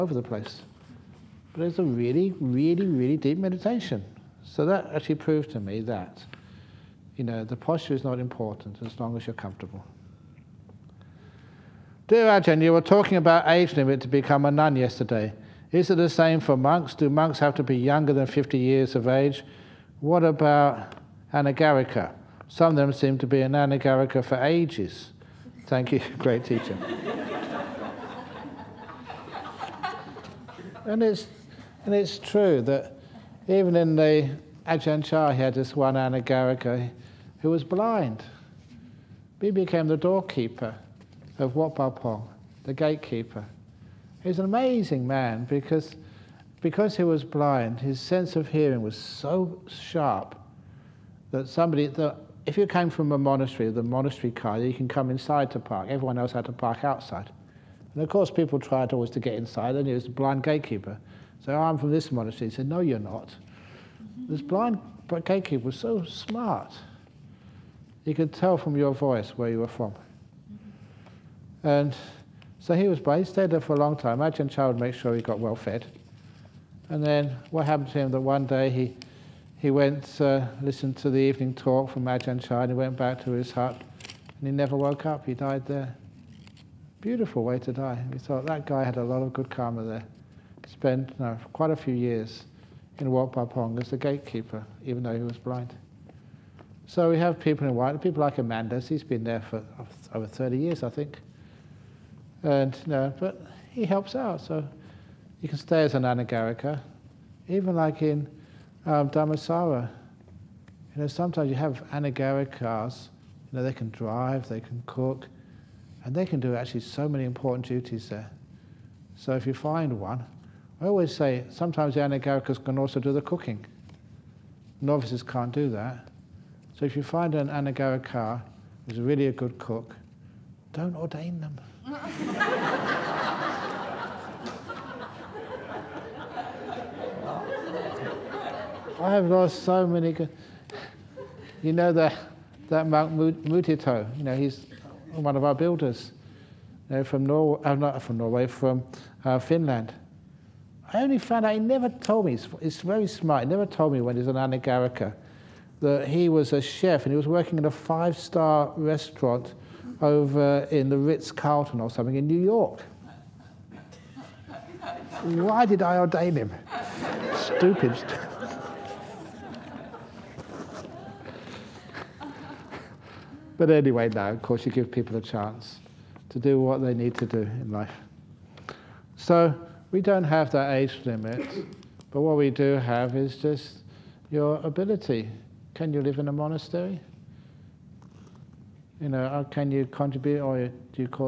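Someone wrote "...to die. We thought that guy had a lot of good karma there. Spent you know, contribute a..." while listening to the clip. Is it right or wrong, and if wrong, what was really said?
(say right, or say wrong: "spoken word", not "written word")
wrong: "quite", not "contribute".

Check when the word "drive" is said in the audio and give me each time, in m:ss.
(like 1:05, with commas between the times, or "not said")
1:53.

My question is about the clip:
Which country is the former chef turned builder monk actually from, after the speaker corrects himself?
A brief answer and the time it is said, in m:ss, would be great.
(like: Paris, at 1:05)
Finland, at 2:29.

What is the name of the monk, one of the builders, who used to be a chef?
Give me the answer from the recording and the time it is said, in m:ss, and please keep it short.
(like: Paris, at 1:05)
Mutito, at 2:23.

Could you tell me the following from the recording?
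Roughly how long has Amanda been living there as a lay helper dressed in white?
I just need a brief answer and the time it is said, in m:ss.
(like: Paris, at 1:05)
over 30 years, at 1:40.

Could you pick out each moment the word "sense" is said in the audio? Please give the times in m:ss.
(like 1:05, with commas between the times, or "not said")
0:47.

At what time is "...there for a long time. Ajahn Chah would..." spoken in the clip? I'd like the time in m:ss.
1:13.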